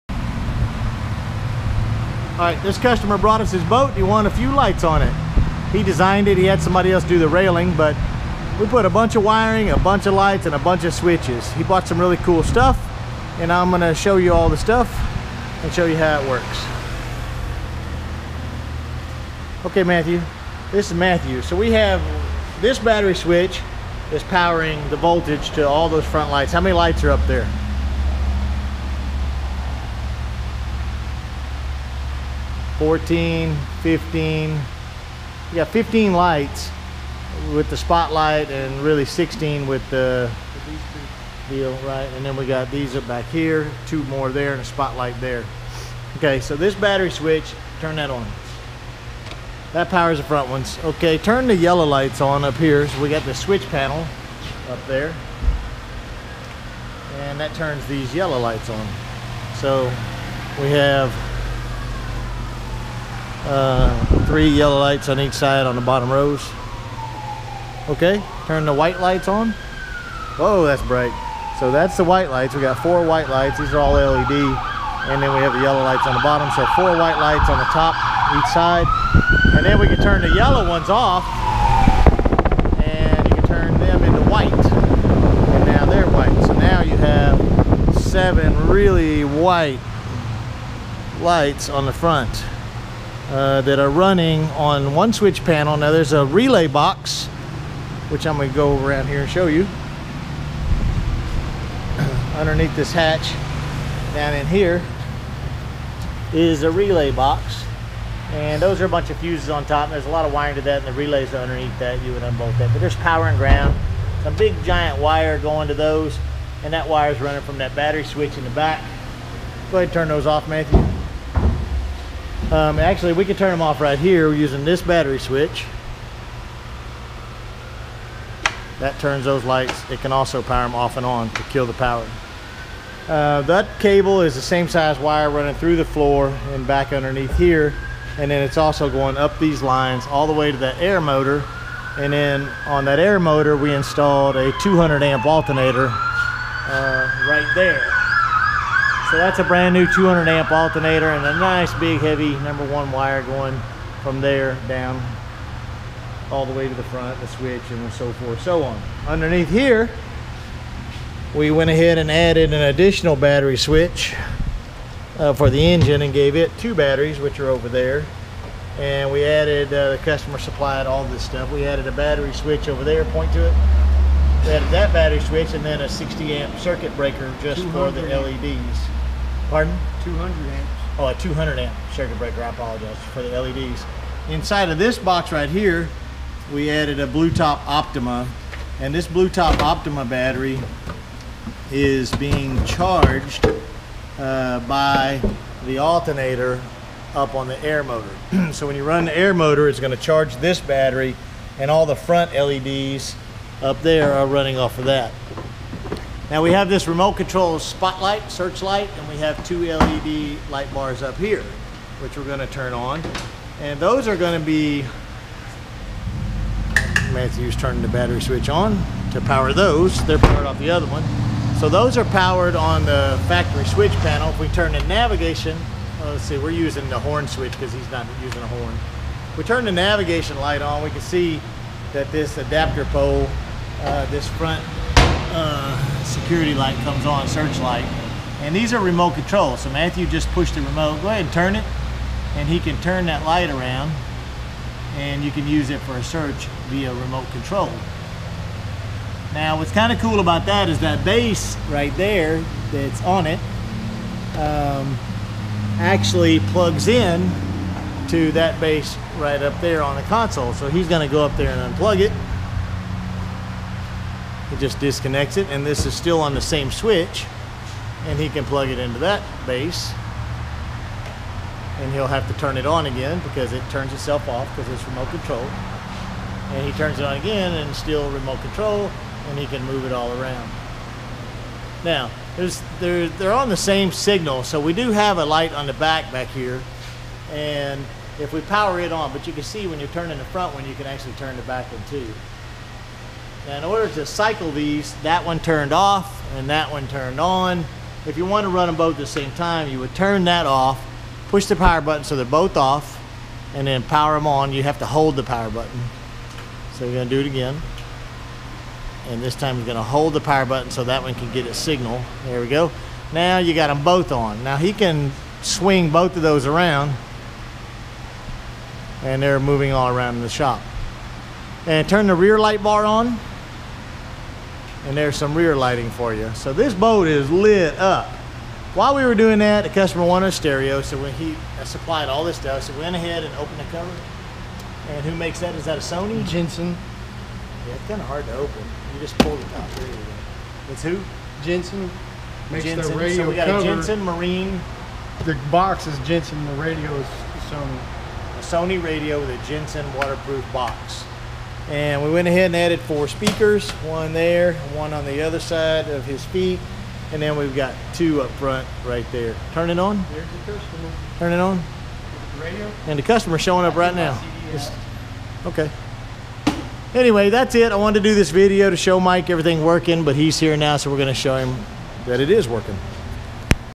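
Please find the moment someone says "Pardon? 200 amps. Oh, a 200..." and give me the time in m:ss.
2:59.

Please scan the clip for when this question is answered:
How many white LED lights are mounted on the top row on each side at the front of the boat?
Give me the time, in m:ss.
1:12.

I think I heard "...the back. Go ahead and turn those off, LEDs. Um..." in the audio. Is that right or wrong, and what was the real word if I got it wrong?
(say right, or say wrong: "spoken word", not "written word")
wrong: "Matthew", not "LEDs".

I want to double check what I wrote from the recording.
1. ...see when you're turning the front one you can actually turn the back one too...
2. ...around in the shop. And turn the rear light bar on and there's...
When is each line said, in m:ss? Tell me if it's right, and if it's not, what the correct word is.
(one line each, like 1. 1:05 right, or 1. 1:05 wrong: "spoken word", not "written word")
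1. 4:49 right
2. 5:19 right.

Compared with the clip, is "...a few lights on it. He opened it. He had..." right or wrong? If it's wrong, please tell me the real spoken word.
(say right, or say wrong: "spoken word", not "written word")
wrong: "designed", not "opened".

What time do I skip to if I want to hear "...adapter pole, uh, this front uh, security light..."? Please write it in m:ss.
3:52.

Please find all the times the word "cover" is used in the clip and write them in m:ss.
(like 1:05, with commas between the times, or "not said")
5:33, 5:43.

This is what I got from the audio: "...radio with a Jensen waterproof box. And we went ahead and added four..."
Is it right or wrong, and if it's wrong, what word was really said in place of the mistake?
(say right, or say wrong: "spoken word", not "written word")
right.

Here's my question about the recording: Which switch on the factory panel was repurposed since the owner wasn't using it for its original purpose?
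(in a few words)
The horn switch.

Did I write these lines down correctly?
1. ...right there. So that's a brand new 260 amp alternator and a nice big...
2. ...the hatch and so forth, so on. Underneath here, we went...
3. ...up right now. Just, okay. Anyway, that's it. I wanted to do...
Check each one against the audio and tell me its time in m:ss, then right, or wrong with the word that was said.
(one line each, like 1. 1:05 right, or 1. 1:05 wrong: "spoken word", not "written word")
1. 2:27 wrong: "200", not "260"
2. 2:37 wrong: "switch", not "hatch"
3. 6:03 right.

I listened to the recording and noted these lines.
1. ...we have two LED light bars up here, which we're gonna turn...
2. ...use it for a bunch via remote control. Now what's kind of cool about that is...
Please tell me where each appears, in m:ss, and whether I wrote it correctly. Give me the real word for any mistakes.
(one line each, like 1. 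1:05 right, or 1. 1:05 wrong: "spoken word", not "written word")
1. 3:29 right
2. 4:05 wrong: "search", not "bunch".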